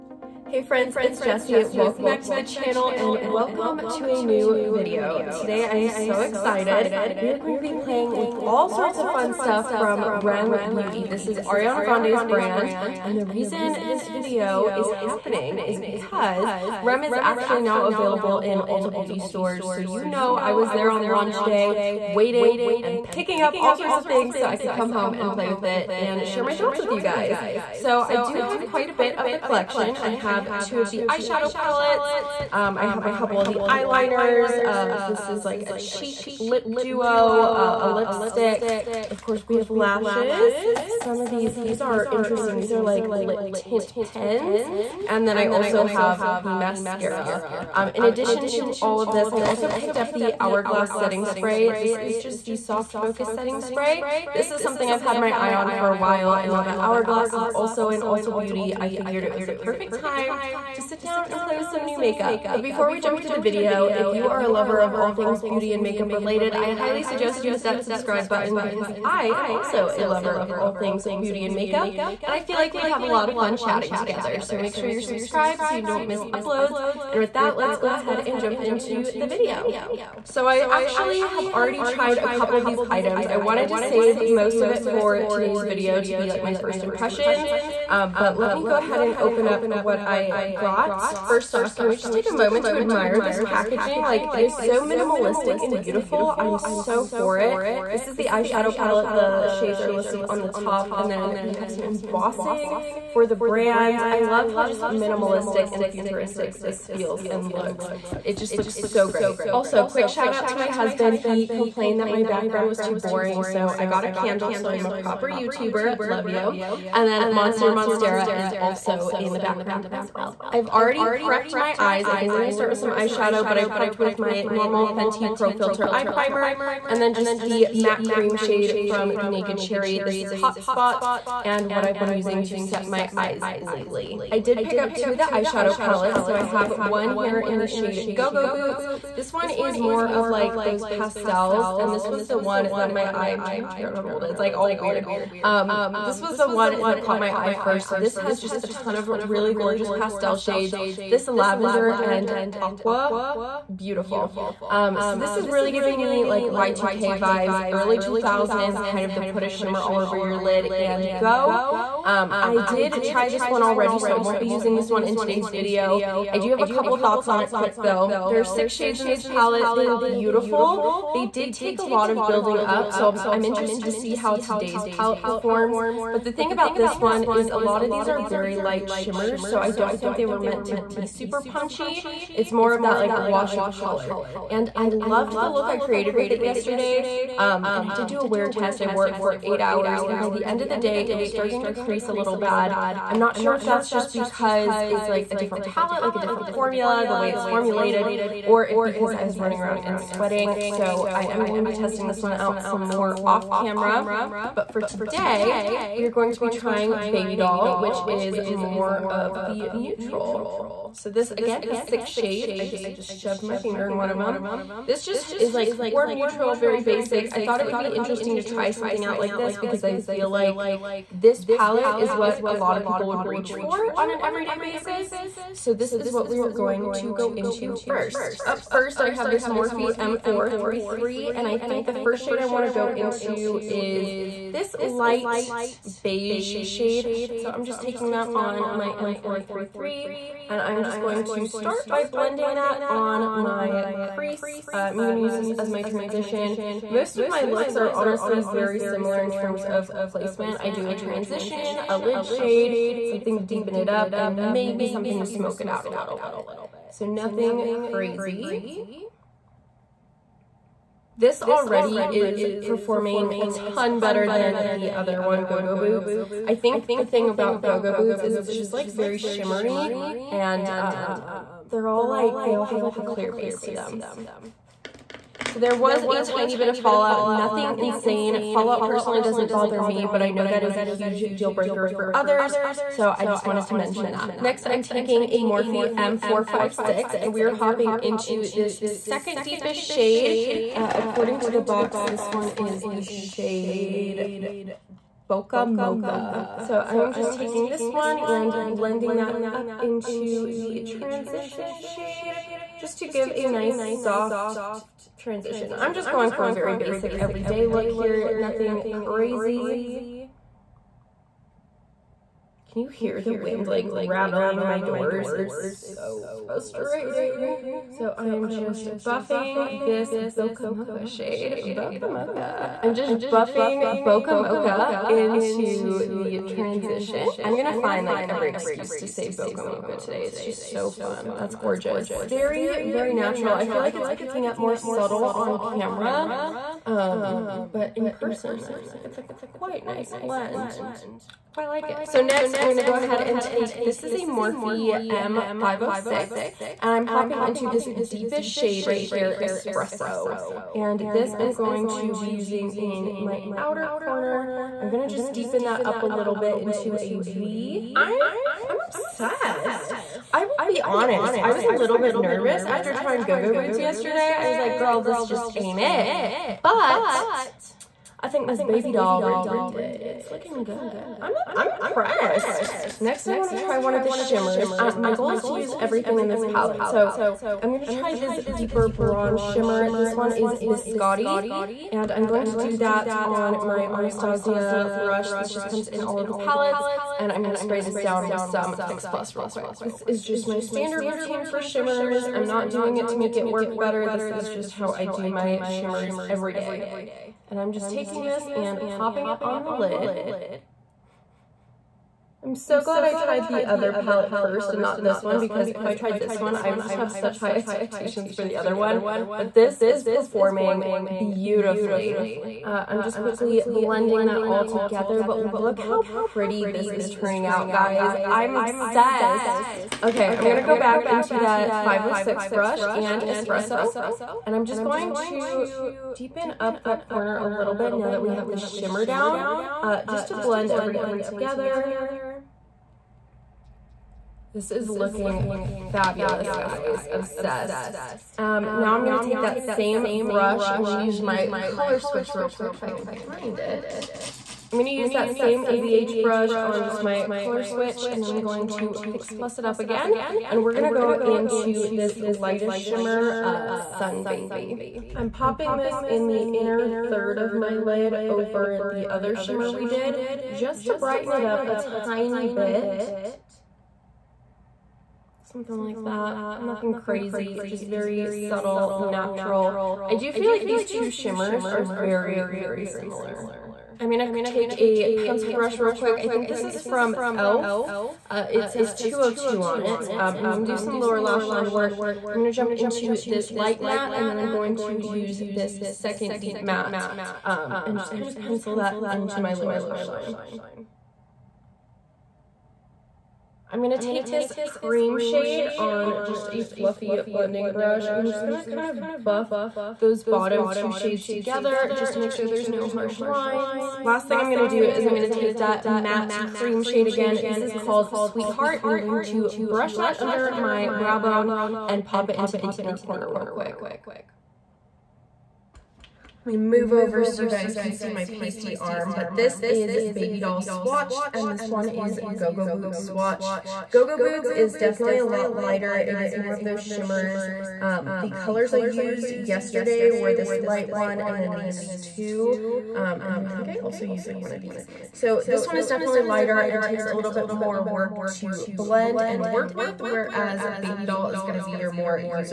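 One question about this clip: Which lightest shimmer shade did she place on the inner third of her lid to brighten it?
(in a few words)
Sun Baby.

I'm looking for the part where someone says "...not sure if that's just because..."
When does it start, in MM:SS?
03:13.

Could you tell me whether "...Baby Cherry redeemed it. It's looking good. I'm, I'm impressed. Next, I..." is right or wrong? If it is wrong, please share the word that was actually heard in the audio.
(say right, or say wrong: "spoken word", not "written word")
wrong: "Doll", not "Cherry".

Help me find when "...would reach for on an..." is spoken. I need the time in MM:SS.
03:43.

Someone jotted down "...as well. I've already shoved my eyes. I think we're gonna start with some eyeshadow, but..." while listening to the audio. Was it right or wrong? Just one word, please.
wrong.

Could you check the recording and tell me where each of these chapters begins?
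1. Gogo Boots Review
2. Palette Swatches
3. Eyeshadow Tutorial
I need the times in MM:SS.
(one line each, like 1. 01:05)
1. 02:16
2. 08:35
3. 03:44.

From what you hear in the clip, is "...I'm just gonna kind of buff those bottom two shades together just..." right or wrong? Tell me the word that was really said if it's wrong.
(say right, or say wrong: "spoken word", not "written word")
right.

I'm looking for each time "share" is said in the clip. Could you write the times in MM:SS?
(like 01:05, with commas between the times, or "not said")
00:26.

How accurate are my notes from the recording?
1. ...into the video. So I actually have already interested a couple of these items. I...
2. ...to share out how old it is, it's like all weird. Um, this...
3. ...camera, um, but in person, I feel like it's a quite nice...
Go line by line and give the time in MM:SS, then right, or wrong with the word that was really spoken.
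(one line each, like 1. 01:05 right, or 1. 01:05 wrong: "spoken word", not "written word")
1. 01:18 wrong: "tried", not "interested"
2. 02:23 wrong: "figure", not "share"
3. 05:35 right.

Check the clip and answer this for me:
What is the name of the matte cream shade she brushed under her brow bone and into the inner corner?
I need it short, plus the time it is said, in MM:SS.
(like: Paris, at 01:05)
Sweetheart, at 08:28.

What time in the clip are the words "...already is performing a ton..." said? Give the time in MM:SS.
04:21.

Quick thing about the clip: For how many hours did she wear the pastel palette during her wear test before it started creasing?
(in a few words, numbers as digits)
8.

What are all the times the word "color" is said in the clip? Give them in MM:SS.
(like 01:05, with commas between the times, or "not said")
03:03, 07:21, 07:27, 08:48.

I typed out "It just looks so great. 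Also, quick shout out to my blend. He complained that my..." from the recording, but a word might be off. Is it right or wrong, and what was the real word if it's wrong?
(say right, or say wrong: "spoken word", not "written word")
wrong: "husband", not "blend".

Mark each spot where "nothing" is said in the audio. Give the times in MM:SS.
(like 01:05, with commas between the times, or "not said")
04:17, 04:37, 05:08, 07:46.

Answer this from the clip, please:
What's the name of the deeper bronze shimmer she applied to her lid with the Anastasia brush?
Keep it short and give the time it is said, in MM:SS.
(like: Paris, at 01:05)
Biscotti, at 06:20.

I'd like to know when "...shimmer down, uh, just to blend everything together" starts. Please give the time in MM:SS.
07:08.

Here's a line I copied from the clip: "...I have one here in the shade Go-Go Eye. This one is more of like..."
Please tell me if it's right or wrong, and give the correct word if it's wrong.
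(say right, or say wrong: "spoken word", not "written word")
wrong: "Boots", not "Eye".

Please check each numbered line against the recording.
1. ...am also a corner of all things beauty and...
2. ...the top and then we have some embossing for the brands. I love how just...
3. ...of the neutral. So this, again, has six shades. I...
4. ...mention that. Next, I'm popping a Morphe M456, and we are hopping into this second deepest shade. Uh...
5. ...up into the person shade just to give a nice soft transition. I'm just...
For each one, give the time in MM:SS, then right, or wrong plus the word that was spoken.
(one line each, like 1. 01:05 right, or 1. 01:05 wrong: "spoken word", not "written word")
1. 01:09 wrong: "lover", not "corner"
2. 01:40 right
3. 03:29 right
4. 04:43 wrong: "taking", not "popping"
5. 04:59 wrong: "transition", not "person".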